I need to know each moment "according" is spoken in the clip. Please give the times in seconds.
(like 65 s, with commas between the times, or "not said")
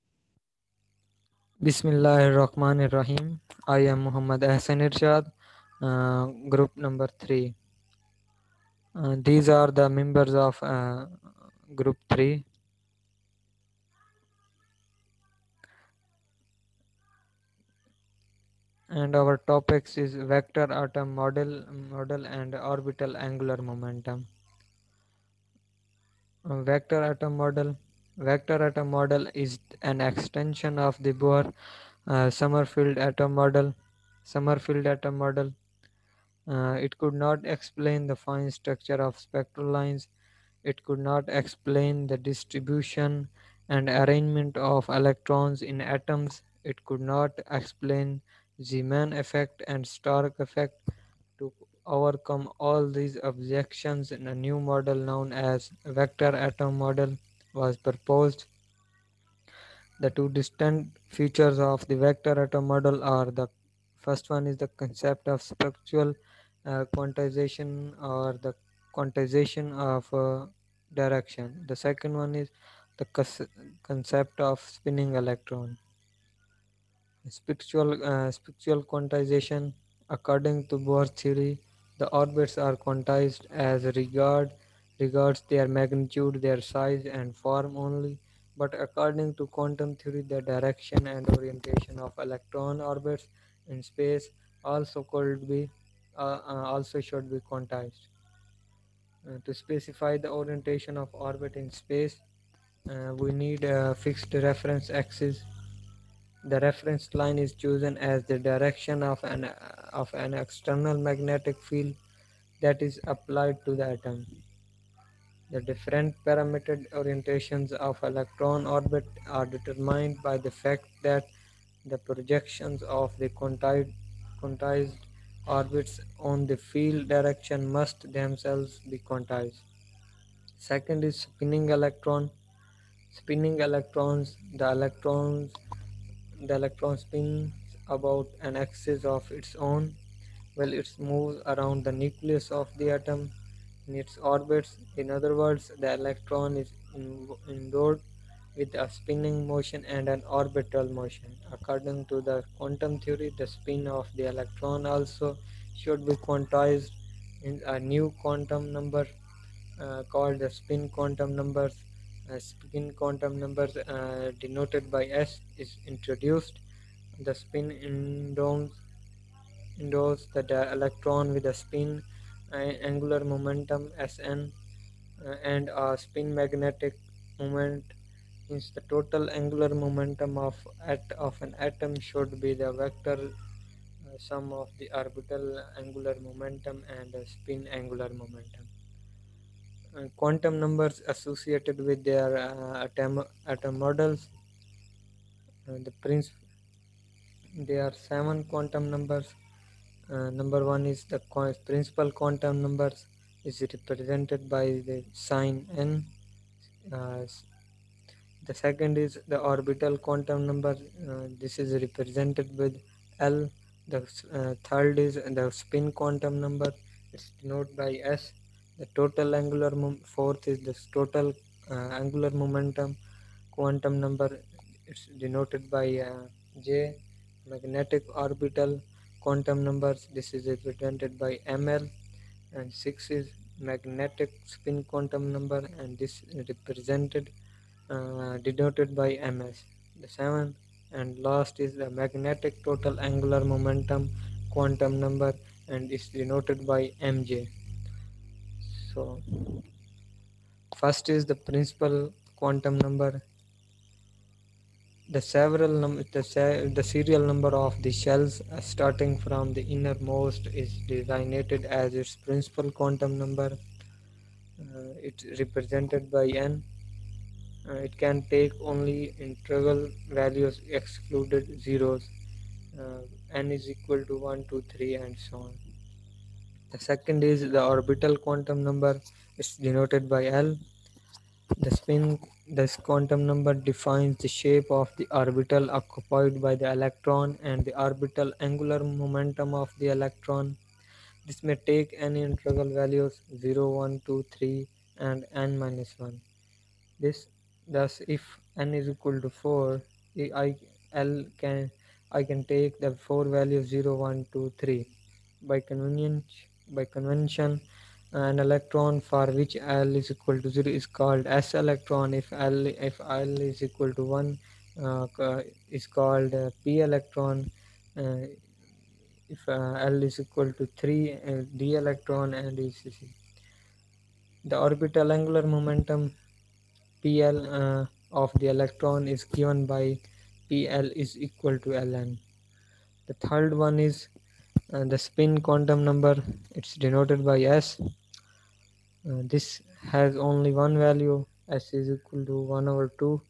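80 s, 88 s, 151 s.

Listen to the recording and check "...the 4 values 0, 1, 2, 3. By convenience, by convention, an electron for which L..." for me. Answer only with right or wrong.
right.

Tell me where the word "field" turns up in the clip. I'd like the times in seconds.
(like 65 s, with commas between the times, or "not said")
111 s, 126 s.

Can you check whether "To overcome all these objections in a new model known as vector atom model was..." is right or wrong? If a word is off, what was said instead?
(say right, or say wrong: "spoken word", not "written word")
right.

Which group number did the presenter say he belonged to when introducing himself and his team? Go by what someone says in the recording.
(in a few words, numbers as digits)
3.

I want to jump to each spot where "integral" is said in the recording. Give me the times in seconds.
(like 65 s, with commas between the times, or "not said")
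269 s, 292 s.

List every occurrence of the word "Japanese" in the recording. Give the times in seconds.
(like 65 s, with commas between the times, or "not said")
not said.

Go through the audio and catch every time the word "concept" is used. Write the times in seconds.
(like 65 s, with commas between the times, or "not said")
64 s, 73 s.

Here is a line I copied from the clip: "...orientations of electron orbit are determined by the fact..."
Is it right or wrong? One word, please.
right.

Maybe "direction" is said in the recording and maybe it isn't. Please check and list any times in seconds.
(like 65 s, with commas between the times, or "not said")
70 s, 90 s, 108 s, 127 s.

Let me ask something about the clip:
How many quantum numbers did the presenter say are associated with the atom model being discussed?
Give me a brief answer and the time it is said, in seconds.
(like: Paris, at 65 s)
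7, at 197 s.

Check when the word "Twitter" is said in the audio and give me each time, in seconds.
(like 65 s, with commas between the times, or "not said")
not said.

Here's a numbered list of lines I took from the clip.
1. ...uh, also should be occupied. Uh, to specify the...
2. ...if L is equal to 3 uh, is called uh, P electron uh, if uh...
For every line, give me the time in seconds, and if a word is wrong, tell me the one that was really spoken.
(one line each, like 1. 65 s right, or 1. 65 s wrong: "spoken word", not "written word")
1. 96 s wrong: "quantized", not "occupied"
2. 312 s wrong: "1", not "3".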